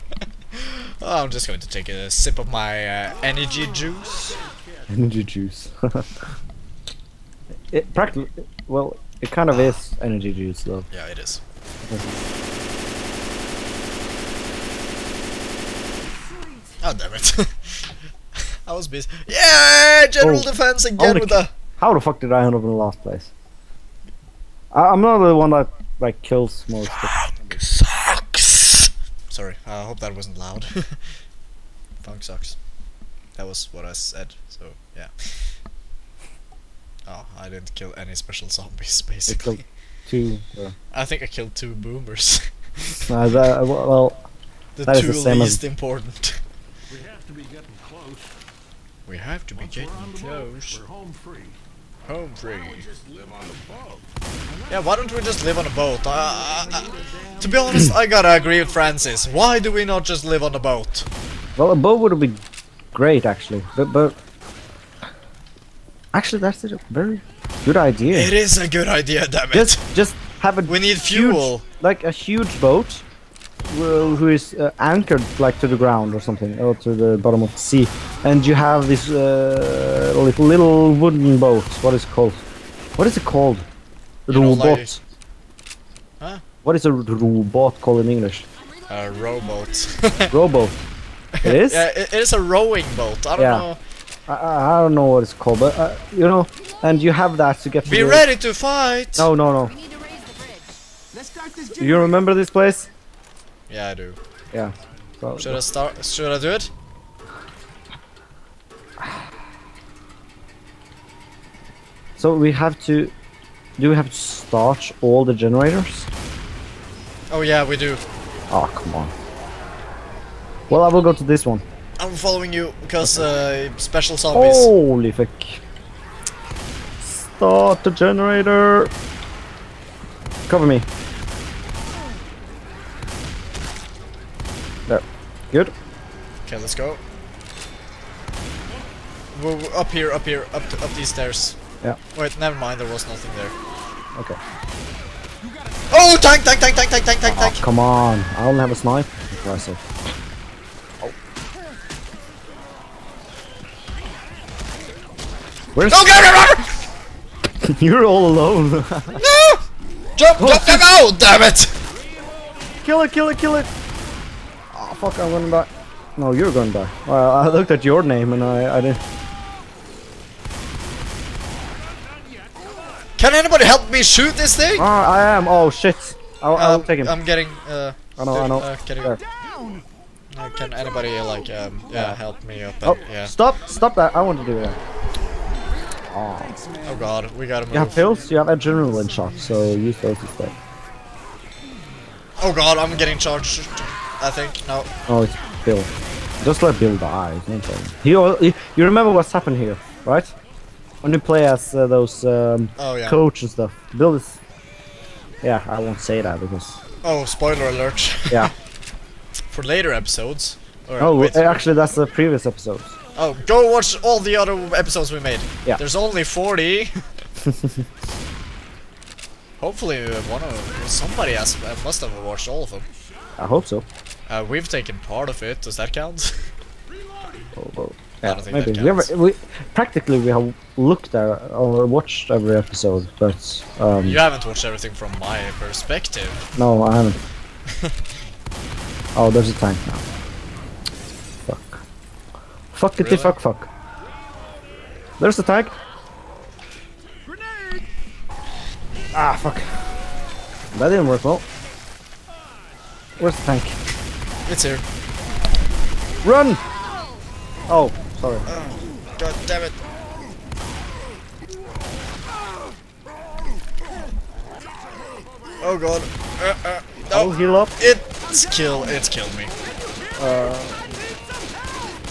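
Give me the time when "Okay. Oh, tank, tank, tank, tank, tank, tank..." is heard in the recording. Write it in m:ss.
2:24.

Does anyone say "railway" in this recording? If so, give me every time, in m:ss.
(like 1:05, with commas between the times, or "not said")
not said.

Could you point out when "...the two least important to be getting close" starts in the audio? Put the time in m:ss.
0:44.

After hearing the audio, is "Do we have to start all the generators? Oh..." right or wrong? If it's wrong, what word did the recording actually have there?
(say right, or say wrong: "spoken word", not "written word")
right.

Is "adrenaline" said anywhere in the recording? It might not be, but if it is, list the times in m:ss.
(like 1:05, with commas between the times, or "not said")
3:08.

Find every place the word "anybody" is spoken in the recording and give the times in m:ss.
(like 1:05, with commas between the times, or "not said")
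2:53, 3:00.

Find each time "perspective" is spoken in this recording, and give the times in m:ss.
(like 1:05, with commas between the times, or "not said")
3:55.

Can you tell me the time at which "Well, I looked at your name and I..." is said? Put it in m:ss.
2:47.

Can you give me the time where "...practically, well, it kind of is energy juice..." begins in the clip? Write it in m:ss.
0:07.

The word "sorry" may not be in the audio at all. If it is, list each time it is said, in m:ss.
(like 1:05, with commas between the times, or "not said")
0:29, 4:18.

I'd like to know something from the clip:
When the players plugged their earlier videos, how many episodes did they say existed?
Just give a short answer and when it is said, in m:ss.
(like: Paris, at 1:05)
40, at 3:36.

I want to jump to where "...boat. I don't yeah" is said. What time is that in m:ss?
1:32.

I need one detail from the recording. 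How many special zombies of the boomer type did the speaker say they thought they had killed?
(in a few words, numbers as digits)
2.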